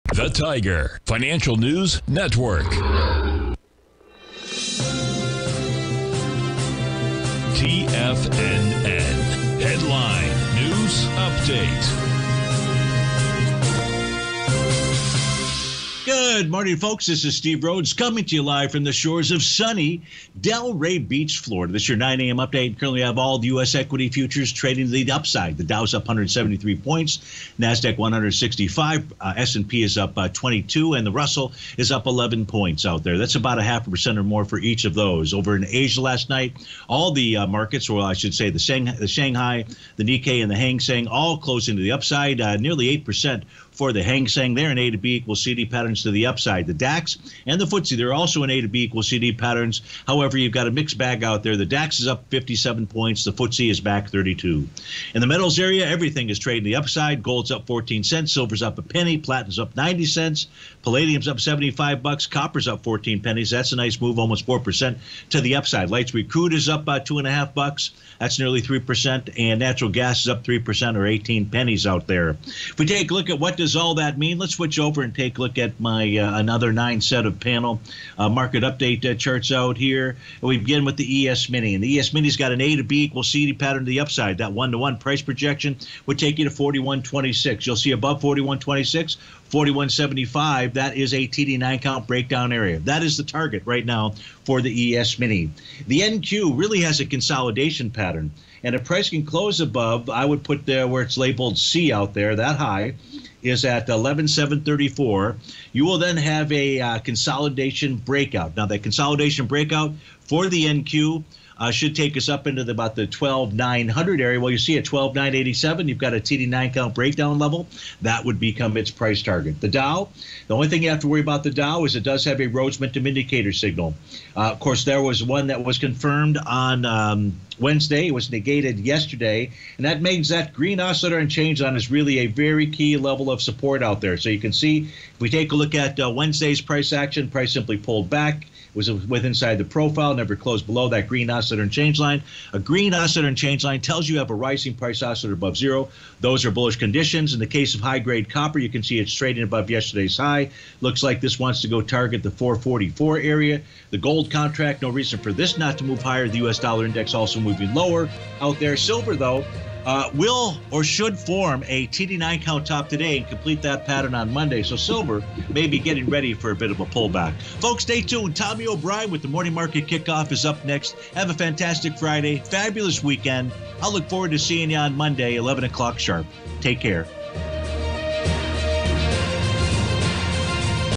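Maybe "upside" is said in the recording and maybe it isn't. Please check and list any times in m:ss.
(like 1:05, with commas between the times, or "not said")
0:25, 0:41, 0:46, 0:56, 1:05, 1:23.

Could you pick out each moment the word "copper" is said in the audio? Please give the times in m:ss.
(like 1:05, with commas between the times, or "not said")
1:02, 2:28.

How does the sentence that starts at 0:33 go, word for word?
That's about a half a percent or more for each of those.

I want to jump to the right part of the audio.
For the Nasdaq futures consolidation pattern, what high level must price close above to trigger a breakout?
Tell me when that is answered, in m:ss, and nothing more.
1:43.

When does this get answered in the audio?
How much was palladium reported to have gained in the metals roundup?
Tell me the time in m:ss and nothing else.
1:01.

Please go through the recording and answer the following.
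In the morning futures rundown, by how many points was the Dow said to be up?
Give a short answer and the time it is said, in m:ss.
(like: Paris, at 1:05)
173, at 0:26.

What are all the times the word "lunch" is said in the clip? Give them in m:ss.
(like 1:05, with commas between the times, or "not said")
not said.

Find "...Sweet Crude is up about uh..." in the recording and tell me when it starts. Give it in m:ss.
1:06.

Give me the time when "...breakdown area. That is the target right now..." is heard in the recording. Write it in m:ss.
1:32.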